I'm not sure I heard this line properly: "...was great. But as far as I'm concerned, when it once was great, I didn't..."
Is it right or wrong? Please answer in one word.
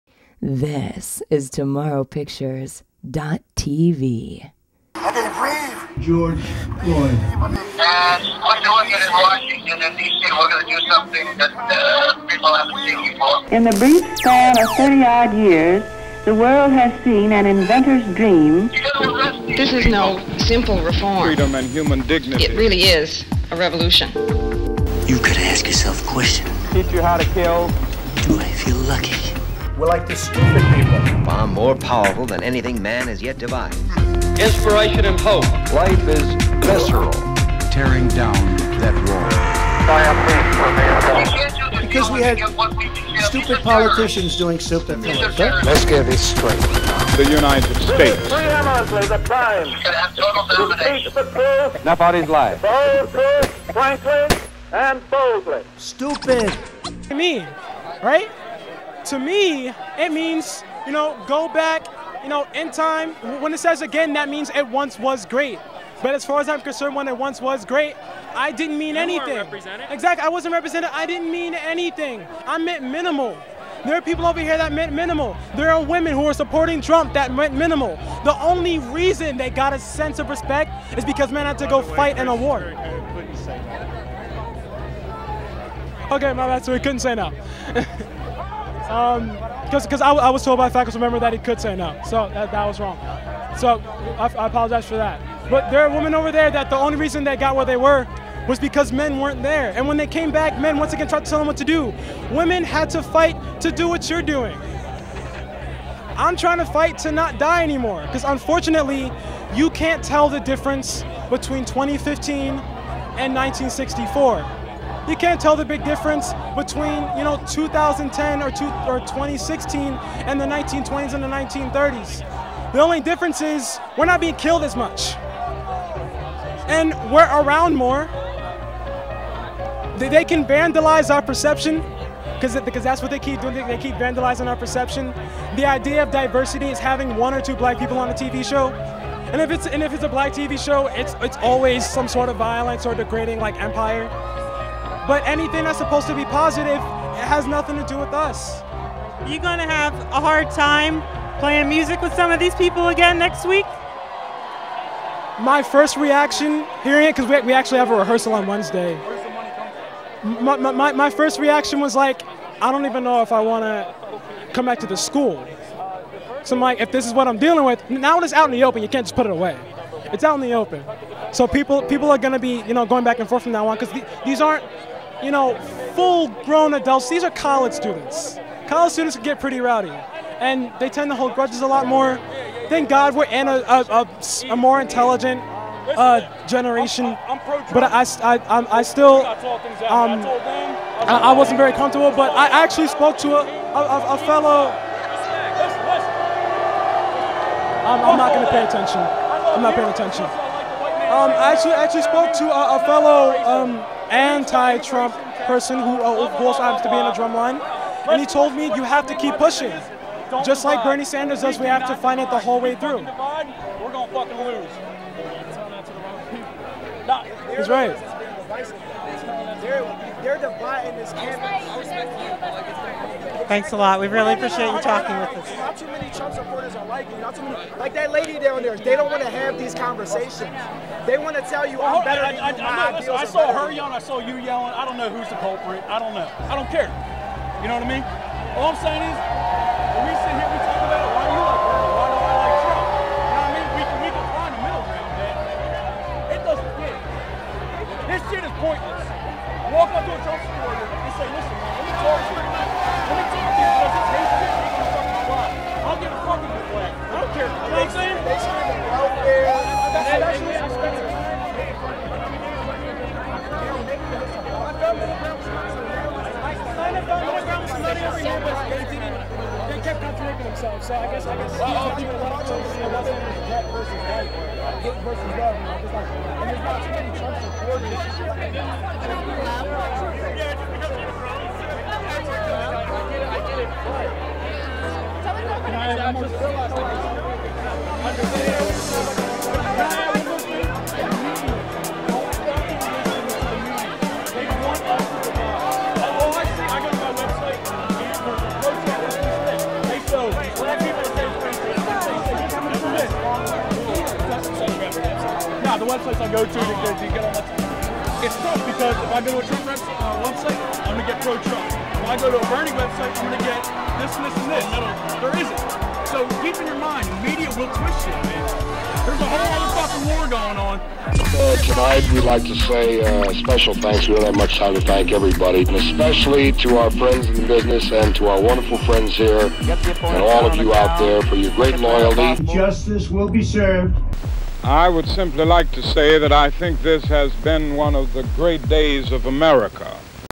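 right.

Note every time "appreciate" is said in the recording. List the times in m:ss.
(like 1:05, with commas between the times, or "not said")
3:44.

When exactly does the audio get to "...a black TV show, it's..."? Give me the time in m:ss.
2:20.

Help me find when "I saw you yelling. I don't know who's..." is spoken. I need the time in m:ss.
3:53.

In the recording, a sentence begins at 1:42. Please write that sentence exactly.
Women had to fight to do what you're doing.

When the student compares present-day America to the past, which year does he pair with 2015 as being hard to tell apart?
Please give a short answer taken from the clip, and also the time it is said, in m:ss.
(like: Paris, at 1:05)
1964, at 1:53.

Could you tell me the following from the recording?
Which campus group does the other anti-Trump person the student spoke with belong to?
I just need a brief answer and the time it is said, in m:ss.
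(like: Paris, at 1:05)
the drumline, at 3:27.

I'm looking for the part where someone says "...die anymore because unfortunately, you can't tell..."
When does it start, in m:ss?
1:47.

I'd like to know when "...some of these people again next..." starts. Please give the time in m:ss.
2:32.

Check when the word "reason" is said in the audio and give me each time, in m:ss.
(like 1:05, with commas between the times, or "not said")
1:18, 1:36.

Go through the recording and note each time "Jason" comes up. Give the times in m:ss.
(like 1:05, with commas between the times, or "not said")
not said.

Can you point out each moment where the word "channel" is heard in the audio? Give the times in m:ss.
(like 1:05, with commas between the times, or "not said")
not said.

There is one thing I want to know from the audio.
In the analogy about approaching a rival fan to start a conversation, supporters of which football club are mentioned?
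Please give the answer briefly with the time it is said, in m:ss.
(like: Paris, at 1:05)
Chelsea, at 4:10.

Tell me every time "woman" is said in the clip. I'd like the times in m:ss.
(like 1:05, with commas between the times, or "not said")
not said.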